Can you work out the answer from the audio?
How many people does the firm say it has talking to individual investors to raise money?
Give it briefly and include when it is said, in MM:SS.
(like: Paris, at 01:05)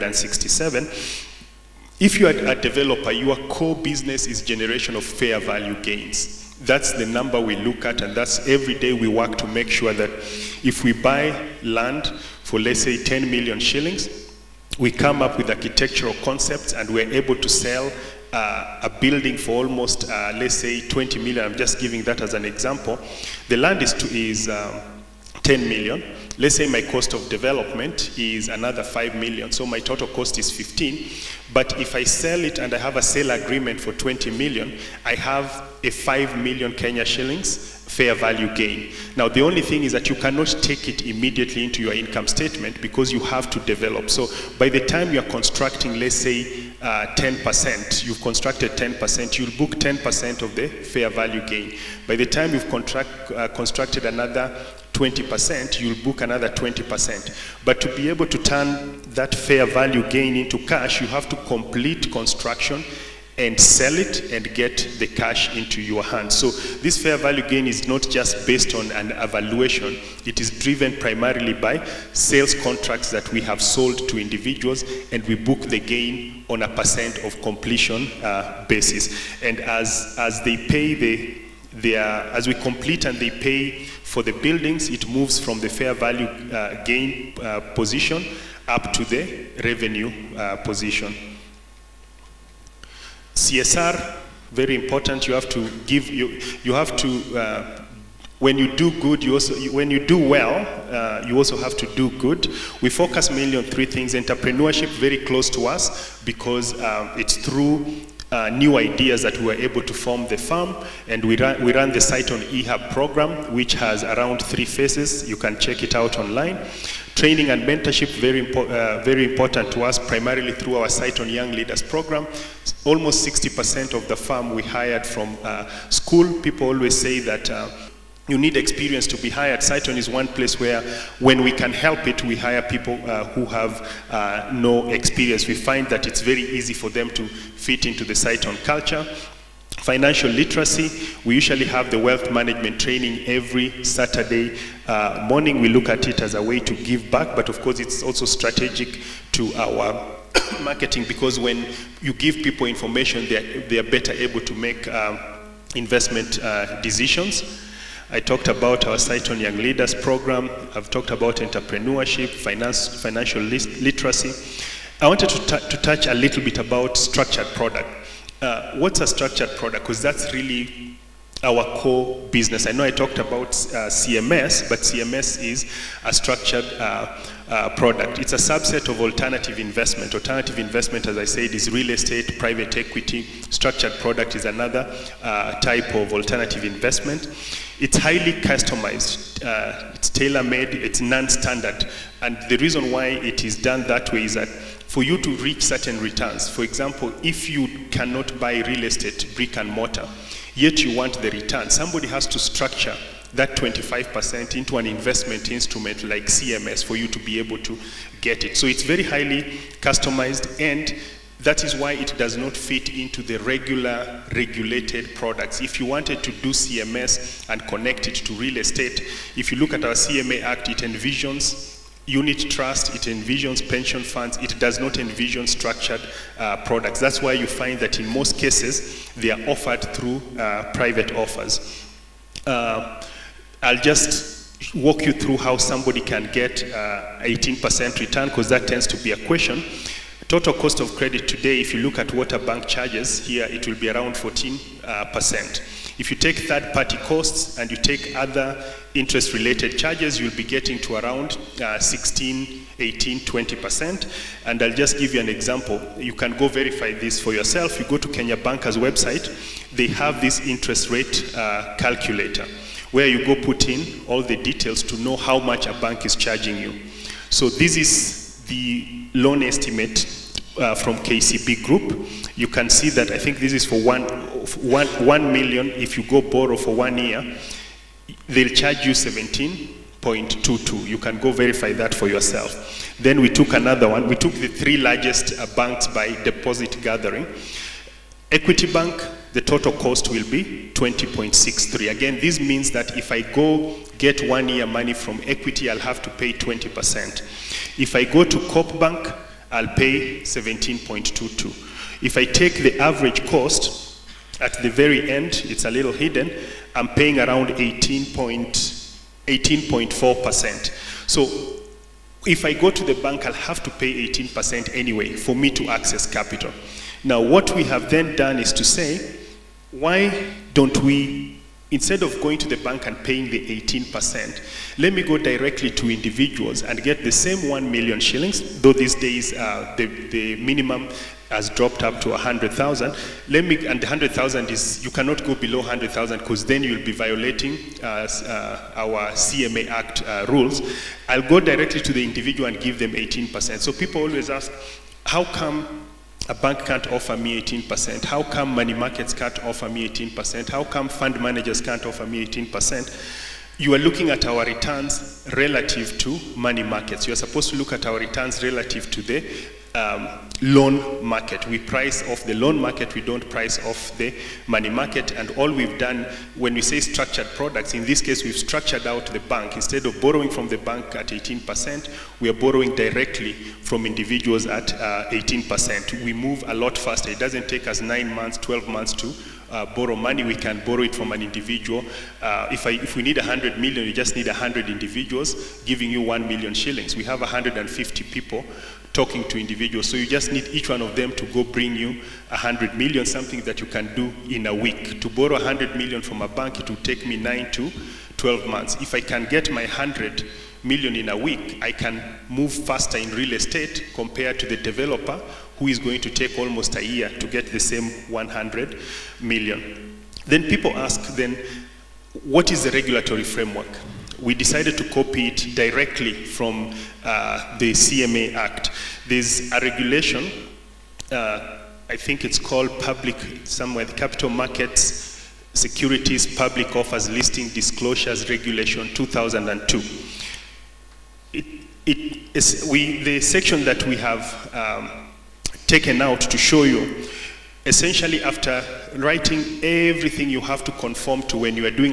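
150, at 06:27.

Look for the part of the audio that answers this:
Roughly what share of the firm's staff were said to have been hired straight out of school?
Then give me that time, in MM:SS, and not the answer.
02:03.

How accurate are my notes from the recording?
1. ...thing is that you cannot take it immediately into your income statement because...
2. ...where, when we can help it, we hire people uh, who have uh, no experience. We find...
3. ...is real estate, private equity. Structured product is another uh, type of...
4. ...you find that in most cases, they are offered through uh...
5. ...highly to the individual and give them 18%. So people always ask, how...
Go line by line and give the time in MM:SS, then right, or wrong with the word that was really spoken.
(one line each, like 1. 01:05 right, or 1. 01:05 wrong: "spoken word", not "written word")
1. 00:39 right
2. 02:10 right
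3. 03:01 right
4. 03:47 right
5. 05:41 wrong: "directly", not "highly".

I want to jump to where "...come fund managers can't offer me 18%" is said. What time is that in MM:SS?
05:50.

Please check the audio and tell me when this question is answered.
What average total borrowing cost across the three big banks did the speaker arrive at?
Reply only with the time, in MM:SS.
05:07.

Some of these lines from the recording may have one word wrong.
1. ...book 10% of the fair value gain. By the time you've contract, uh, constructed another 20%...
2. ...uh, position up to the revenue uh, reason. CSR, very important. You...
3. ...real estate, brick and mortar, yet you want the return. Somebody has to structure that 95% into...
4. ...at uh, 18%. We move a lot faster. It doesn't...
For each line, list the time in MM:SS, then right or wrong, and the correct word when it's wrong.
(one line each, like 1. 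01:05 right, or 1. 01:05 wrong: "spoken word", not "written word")
1. 00:49 right
2. 01:27 wrong: "position", not "reason"
3. 03:18 wrong: "25", not "95"
4. 06:14 right.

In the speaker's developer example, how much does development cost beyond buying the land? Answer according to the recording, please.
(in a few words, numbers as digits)
5 million.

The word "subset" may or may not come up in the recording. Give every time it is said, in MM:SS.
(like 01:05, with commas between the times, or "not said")
02:58.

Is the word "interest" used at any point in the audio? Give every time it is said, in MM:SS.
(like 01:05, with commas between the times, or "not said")
04:08, 04:20.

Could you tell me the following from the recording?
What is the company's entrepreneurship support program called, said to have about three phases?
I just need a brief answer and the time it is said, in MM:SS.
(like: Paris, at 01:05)
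Cytonn eHub, at 01:51.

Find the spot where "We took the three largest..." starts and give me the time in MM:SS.
04:44.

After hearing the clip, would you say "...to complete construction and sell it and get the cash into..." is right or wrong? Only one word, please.
right.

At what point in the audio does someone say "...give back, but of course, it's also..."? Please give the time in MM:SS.
02:26.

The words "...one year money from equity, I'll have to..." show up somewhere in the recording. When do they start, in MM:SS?
04:54.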